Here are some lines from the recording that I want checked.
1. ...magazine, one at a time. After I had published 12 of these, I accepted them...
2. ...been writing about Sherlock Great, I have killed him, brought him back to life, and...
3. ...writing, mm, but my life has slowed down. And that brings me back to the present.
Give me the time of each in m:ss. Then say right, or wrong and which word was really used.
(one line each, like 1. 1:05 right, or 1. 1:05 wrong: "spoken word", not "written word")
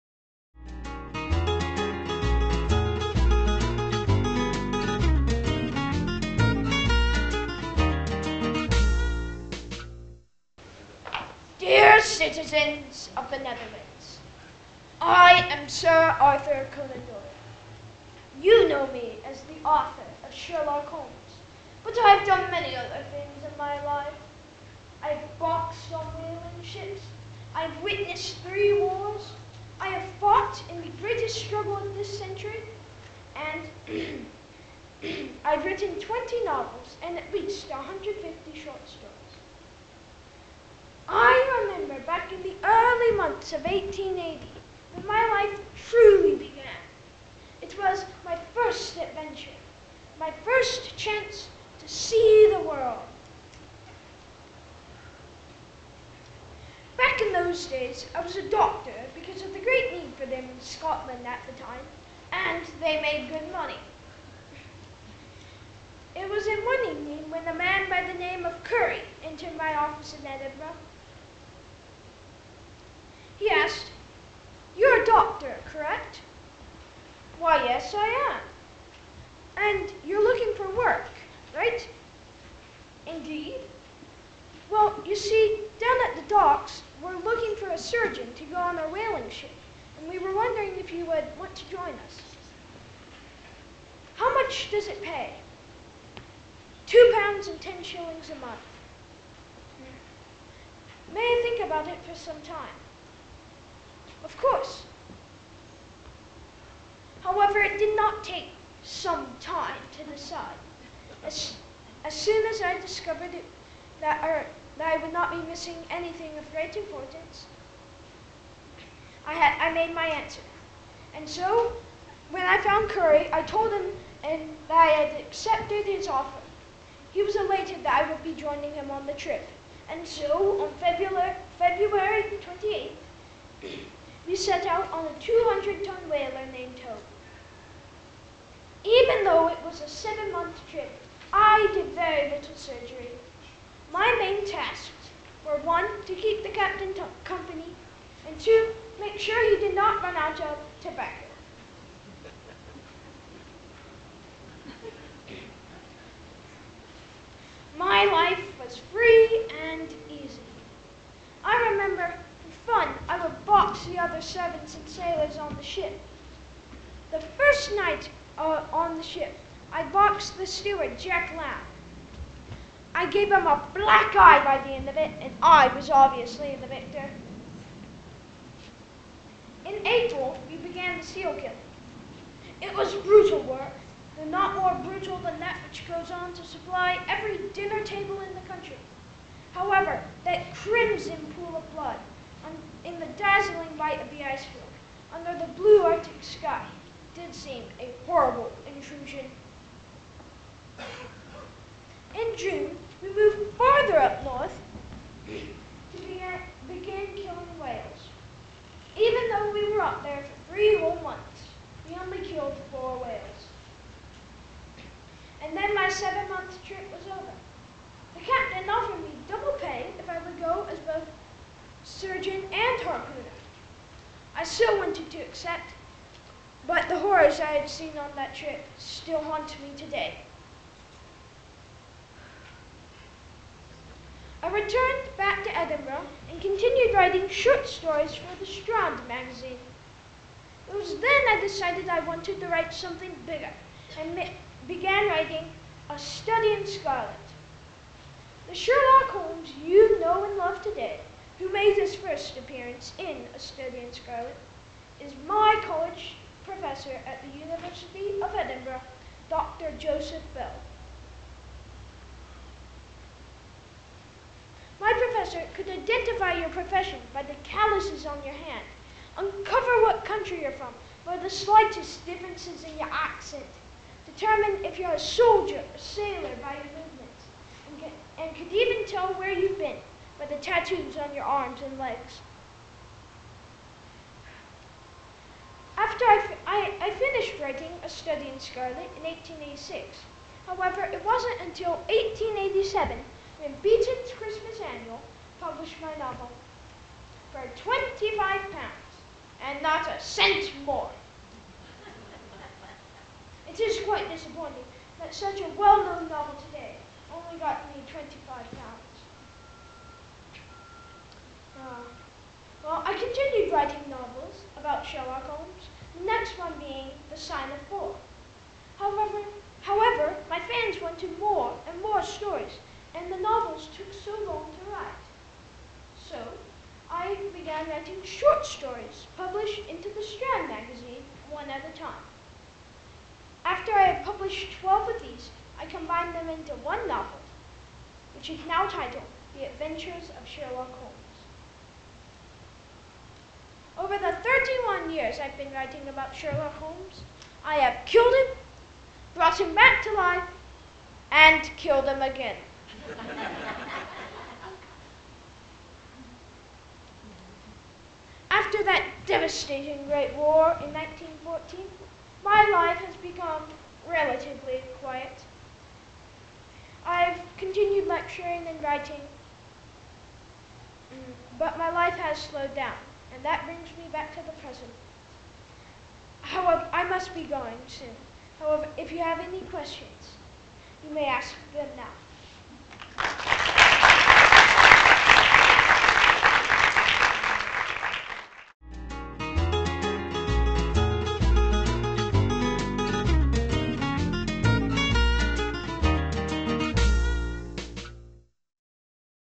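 1. 5:30 wrong: "combined", not "accepted"
2. 5:45 wrong: "Holmes", not "Great"
3. 6:08 right.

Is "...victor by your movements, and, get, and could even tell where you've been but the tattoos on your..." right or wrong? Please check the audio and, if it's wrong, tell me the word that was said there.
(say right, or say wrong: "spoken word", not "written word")
wrong: "sailor", not "victor".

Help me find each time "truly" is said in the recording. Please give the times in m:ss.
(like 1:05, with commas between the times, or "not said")
0:45.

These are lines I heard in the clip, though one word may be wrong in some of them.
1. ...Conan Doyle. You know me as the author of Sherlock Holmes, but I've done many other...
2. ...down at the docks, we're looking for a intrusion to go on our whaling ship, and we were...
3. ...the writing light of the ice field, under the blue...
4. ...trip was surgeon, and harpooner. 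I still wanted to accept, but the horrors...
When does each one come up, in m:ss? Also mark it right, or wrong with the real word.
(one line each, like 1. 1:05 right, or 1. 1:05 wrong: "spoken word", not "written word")
1. 0:16 right
2. 1:25 wrong: "surgeon", not "intrusion"
3. 3:12 wrong: "dazzling", not "writing"
4. 3:36 right.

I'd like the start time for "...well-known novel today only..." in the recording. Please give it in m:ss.
5:05.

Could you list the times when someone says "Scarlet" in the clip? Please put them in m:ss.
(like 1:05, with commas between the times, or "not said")
4:06, 4:13, 4:48.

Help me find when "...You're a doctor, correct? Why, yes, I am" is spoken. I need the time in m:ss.
1:14.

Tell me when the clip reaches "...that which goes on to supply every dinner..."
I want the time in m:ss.
3:05.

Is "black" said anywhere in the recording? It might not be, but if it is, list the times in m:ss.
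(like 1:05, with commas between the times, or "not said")
2:53.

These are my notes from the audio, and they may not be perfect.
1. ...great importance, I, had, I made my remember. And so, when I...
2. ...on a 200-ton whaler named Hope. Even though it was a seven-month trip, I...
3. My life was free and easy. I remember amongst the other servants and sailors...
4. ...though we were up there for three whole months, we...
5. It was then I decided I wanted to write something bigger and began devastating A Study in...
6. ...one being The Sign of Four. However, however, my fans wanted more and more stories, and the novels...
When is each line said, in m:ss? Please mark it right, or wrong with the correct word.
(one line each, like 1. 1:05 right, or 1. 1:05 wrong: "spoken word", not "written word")
1. 1:56 wrong: "answer", not "remember"
2. 2:14 right
3. 2:37 right
4. 3:29 right
5. 4:00 wrong: "writing", not "devastating"
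6. 5:16 right.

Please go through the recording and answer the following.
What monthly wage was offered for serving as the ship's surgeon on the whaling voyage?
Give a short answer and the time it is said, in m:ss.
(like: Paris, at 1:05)
Two pounds and ten shillings, at 1:36.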